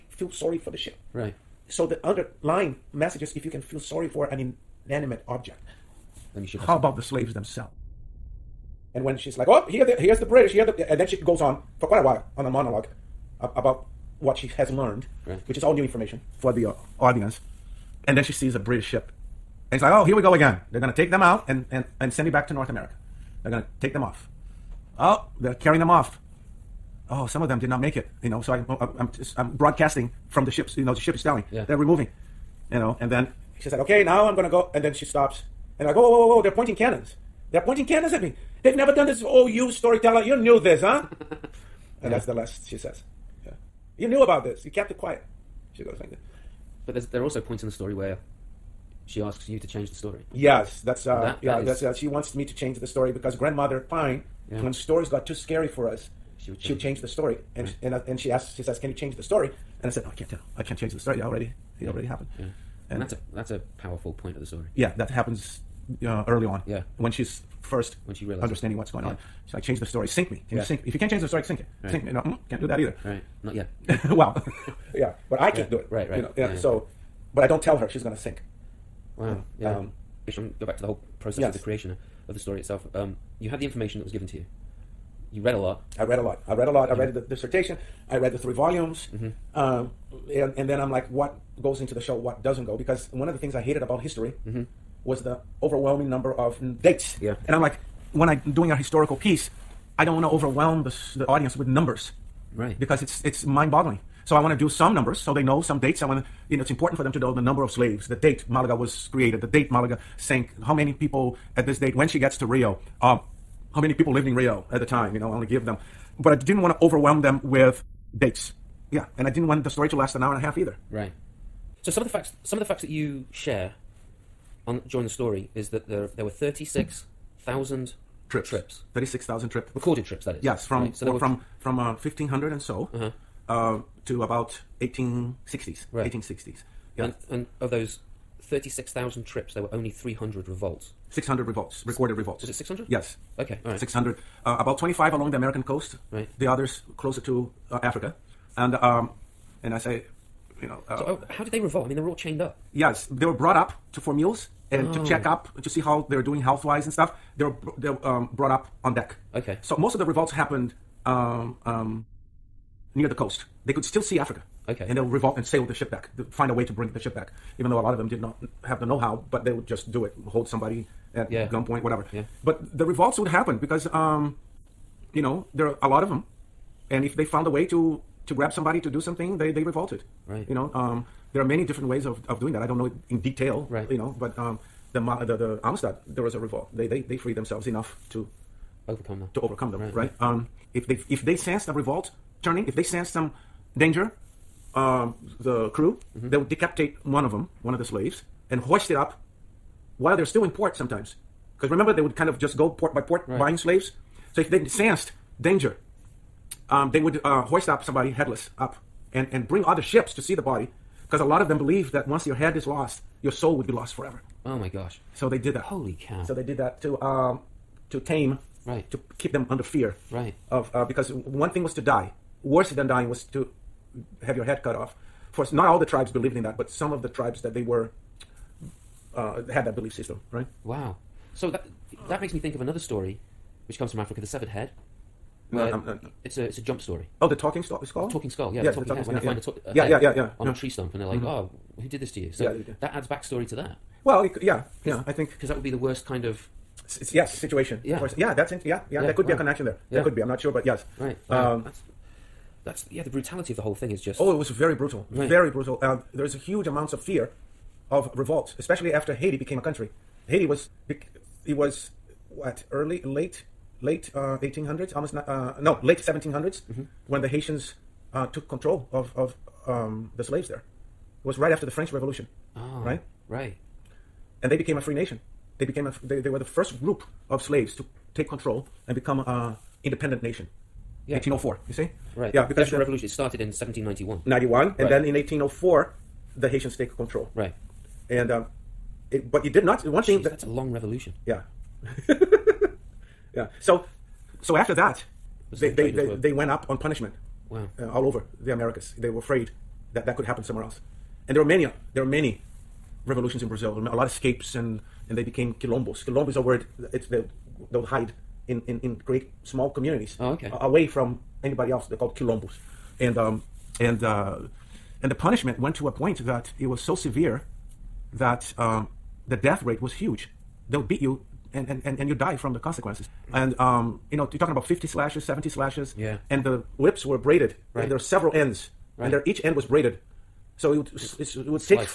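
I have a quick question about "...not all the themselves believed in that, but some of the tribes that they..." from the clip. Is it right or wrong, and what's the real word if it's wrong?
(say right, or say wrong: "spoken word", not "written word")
wrong: "tribes", not "themselves".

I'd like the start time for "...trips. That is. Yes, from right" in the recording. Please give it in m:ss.
2:10.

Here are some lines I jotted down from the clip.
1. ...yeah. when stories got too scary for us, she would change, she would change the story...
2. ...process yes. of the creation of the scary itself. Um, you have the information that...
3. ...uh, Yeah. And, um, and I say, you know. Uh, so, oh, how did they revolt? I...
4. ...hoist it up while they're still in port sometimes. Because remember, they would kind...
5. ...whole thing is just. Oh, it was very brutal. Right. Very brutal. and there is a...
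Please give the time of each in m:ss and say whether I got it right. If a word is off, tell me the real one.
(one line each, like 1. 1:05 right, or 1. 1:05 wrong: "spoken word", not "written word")
1. 0:54 right
2. 1:21 wrong: "story", not "scary"
3. 2:27 wrong: "Africa", not "Yeah"
4. 3:18 right
5. 4:13 right.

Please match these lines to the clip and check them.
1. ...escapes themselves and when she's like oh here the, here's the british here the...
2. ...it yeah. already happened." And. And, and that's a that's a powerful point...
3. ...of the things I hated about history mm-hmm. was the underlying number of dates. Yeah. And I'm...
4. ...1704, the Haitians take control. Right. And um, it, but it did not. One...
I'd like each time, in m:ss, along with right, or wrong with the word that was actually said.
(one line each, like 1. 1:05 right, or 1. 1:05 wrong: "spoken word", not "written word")
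1. 0:07 wrong: "slaves", not "escapes"
2. 1:01 wrong: "Yeah", not "And"
3. 1:33 wrong: "overwhelming", not "underlying"
4. 4:45 wrong: "1804", not "1704".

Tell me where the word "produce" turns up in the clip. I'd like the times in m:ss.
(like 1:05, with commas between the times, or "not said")
not said.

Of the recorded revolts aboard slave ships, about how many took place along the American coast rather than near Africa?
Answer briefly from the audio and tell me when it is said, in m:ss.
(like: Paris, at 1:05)
25, at 2:24.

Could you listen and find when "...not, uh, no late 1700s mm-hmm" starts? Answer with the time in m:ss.
4:25.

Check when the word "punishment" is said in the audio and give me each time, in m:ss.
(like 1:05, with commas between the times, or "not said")
4:56, 5:15.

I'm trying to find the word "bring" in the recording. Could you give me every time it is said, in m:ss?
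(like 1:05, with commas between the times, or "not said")
2:46, 3:29.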